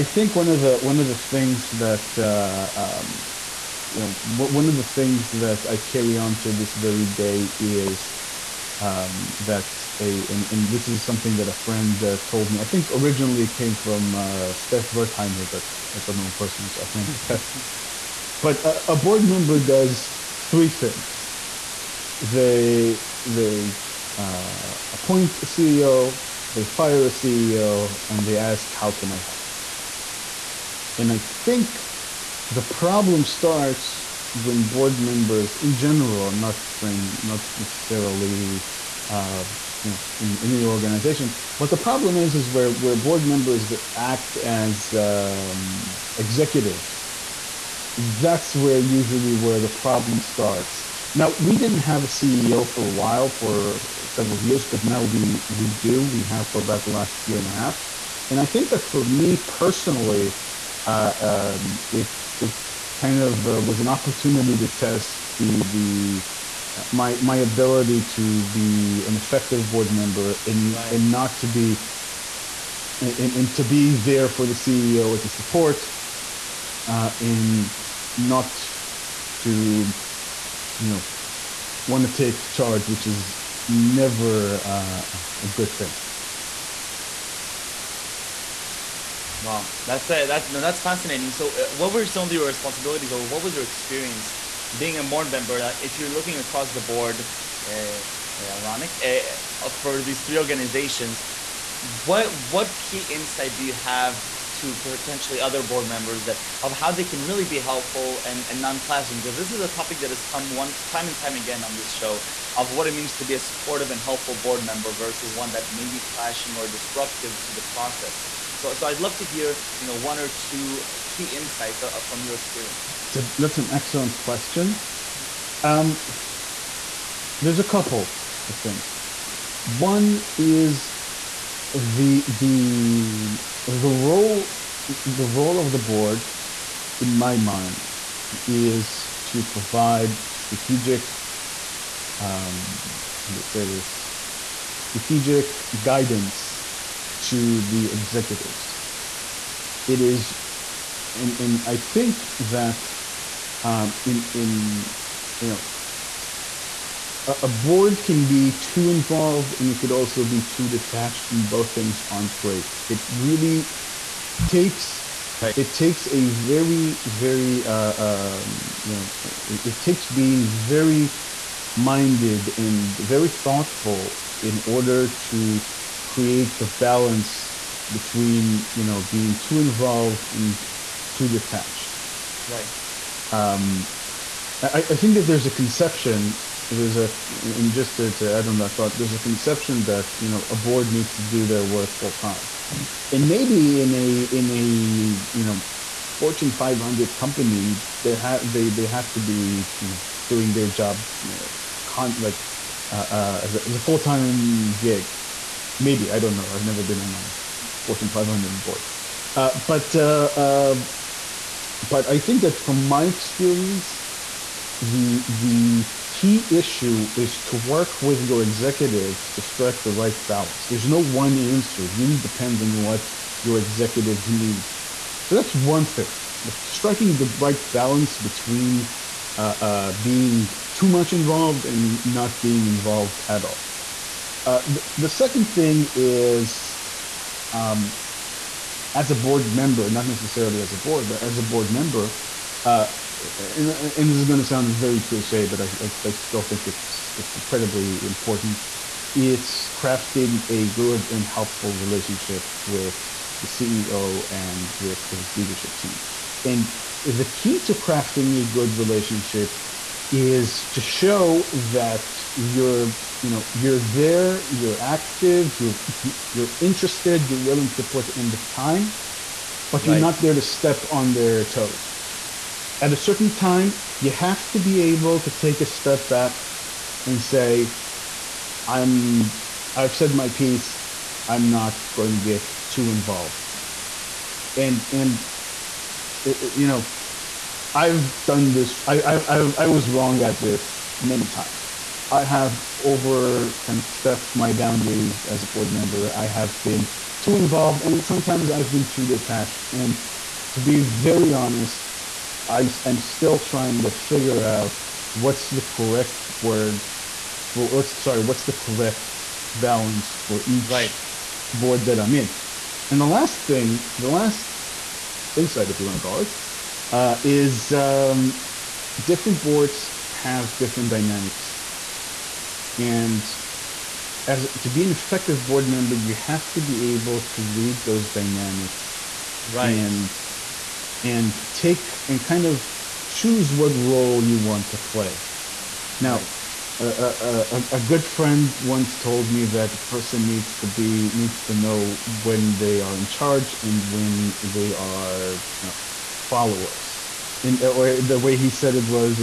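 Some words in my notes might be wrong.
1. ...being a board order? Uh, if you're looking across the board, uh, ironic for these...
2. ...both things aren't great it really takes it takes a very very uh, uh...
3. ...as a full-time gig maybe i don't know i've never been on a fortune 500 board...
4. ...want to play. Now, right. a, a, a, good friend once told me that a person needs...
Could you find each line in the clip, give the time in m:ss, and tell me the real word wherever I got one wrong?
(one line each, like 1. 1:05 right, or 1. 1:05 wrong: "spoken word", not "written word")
1. 1:34 wrong: "member", not "order"
2. 2:41 right
3. 3:23 right
4. 5:34 right.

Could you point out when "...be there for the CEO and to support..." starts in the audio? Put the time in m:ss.
1:13.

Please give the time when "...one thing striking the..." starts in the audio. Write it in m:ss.
3:45.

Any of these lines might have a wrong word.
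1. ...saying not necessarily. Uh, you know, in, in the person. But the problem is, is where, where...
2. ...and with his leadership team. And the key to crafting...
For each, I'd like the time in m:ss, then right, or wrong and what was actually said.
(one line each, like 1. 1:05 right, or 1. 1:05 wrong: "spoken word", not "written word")
1. 0:36 wrong: "organization", not "person"
2. 4:14 right.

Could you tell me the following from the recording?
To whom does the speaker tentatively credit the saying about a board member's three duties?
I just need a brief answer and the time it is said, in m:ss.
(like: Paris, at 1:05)
Stef Wertheimer, at 0:14.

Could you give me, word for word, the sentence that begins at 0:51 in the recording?
Now we didn't have a CEO for a while, for several years, but now we we do.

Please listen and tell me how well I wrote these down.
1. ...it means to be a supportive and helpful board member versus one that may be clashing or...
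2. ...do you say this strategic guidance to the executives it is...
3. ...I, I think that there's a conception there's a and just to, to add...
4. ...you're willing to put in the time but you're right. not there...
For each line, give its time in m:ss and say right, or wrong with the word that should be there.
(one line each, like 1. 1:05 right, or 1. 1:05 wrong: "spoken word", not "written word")
1. 1:52 right
2. 2:23 right
3. 3:04 right
4. 4:27 right.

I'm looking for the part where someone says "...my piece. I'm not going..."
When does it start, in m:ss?
4:40.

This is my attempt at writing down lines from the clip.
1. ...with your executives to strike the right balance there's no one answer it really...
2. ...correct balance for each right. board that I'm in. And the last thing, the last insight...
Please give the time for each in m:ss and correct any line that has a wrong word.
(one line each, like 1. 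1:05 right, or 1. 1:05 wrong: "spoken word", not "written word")
1. 3:38 right
2. 5:08 right.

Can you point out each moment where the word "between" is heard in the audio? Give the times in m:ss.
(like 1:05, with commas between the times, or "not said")
2:57, 3:48.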